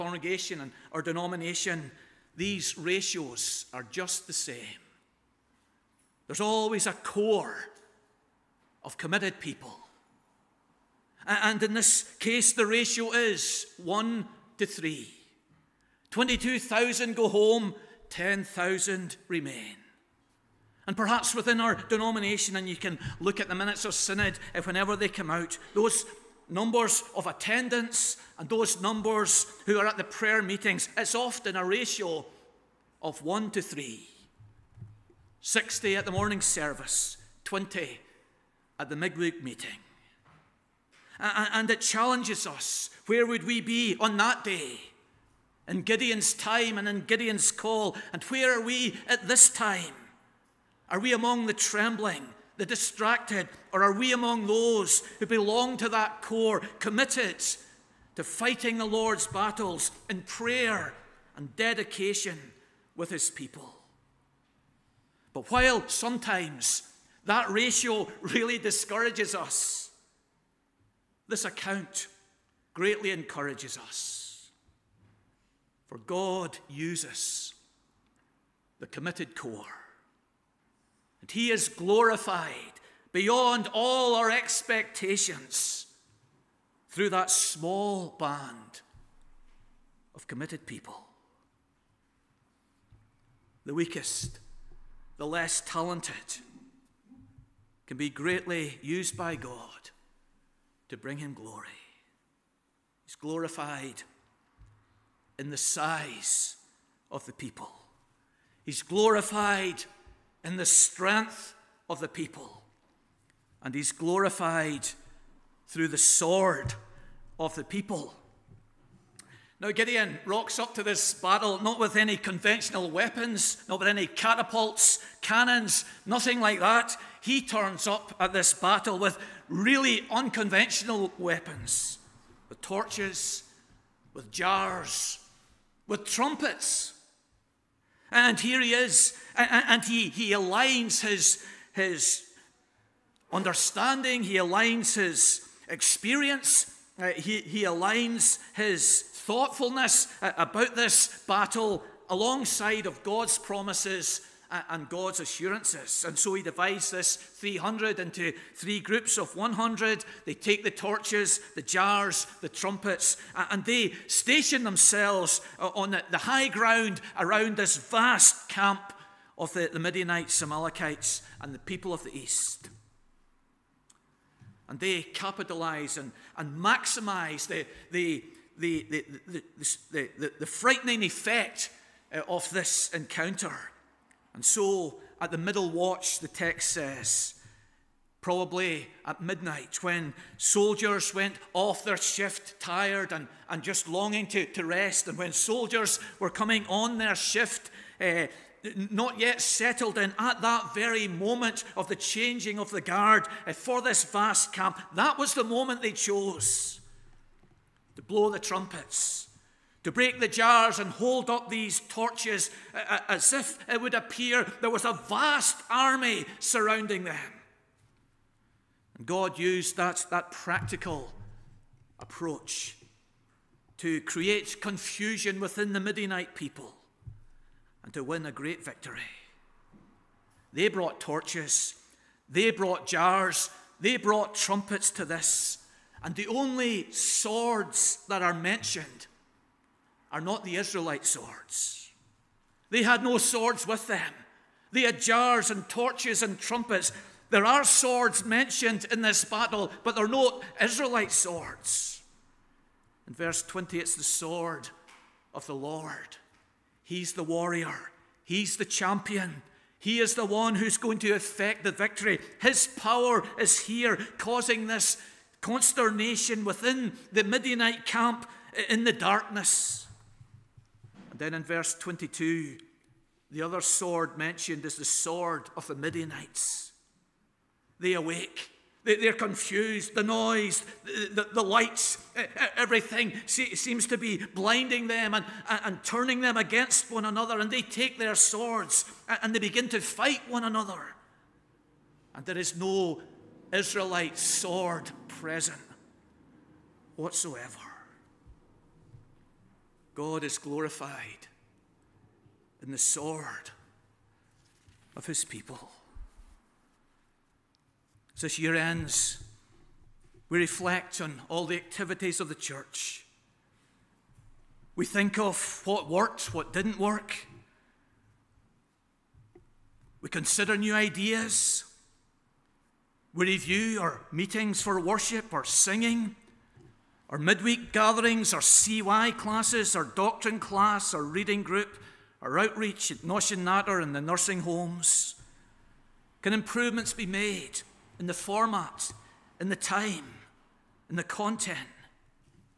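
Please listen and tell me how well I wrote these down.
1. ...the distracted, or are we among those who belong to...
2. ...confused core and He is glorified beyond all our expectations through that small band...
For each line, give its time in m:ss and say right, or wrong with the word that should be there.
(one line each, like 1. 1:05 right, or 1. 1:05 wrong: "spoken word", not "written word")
1. 0:52 right
2. 1:18 wrong: "committed", not "confused".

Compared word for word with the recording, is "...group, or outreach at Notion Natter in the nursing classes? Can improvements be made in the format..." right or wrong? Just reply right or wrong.
wrong.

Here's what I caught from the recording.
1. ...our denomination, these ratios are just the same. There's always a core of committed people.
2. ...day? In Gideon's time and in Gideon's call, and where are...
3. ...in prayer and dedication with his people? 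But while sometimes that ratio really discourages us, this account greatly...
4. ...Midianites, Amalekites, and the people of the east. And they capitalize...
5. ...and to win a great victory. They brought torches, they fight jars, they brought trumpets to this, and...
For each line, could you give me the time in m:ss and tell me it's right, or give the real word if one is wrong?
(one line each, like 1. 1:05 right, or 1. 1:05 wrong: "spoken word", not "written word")
1. 0:00 right
2. 0:44 right
3. 1:00 right
4. 2:49 right
5. 3:47 wrong: "brought", not "fight".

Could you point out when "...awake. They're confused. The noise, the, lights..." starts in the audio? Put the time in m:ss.
4:37.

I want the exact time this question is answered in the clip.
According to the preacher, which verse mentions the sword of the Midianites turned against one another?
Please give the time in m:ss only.
4:31.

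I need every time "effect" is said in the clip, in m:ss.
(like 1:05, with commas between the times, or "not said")
3:01, 4:21.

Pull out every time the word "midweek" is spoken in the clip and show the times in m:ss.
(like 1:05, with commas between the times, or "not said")
0:38, 5:27.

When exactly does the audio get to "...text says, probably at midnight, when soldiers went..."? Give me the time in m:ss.
3:06.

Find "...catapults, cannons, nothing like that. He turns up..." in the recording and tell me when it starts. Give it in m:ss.
2:04.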